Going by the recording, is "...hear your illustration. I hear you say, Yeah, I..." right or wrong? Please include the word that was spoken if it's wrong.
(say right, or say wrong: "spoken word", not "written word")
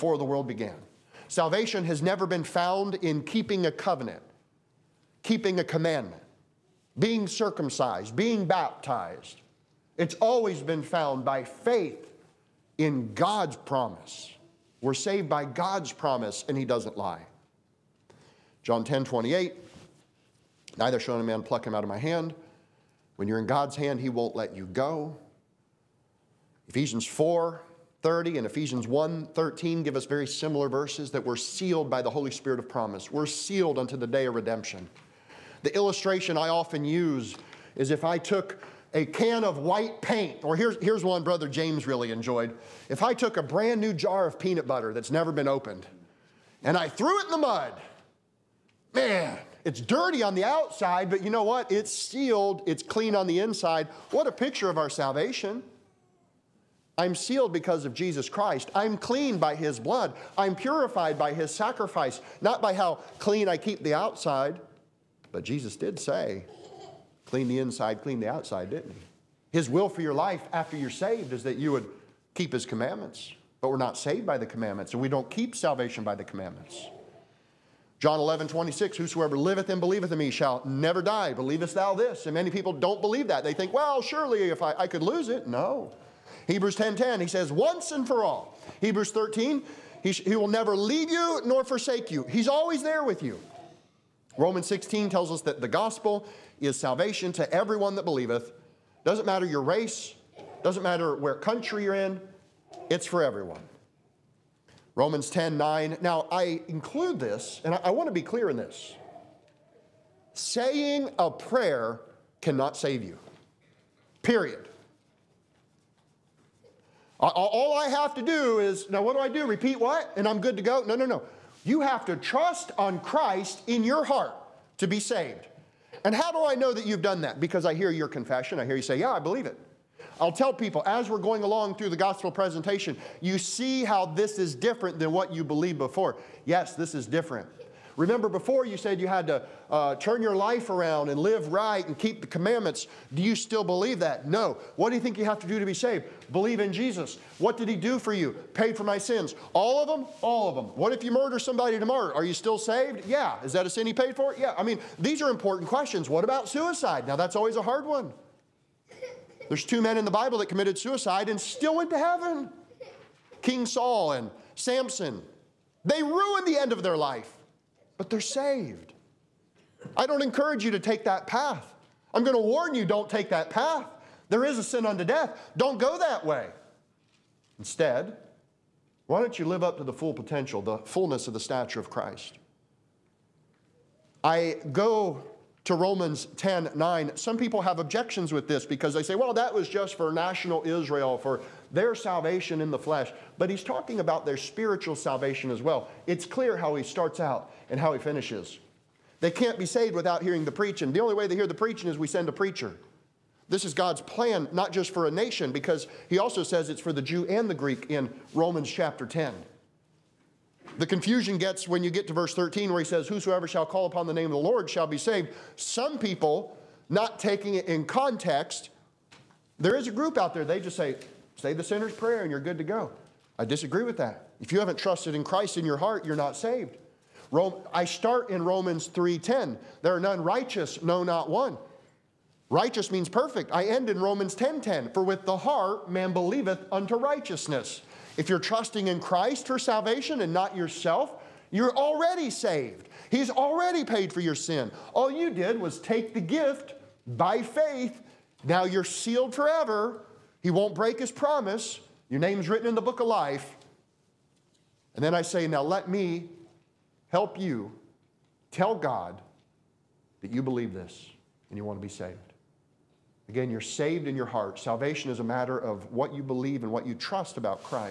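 wrong: "confession", not "illustration".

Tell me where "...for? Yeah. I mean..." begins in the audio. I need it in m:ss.
2:34.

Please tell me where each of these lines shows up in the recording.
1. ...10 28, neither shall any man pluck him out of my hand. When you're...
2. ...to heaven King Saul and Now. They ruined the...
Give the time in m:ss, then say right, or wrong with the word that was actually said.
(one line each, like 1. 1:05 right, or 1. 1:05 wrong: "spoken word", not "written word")
1. 0:18 right
2. 2:41 wrong: "Samson", not "Now".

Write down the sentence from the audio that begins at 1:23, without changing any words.
They think, well, surely if I, I could lose it.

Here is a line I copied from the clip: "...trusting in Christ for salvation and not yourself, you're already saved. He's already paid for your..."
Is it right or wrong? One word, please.
right.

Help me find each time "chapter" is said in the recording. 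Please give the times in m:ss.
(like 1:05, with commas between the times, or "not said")
3:28.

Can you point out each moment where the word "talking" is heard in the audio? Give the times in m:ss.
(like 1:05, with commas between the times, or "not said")
3:13.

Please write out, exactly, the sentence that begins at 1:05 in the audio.
But Jesus did say, clean the inside, clean the outside, didn't he?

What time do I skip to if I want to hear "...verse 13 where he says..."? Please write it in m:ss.
3:32.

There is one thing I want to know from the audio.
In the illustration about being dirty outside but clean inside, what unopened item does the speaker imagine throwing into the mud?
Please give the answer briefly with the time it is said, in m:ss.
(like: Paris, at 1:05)
jar of peanut butter, at 0:43.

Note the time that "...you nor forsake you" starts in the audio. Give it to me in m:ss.
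1:31.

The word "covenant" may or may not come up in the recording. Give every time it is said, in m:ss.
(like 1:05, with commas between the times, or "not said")
0:03.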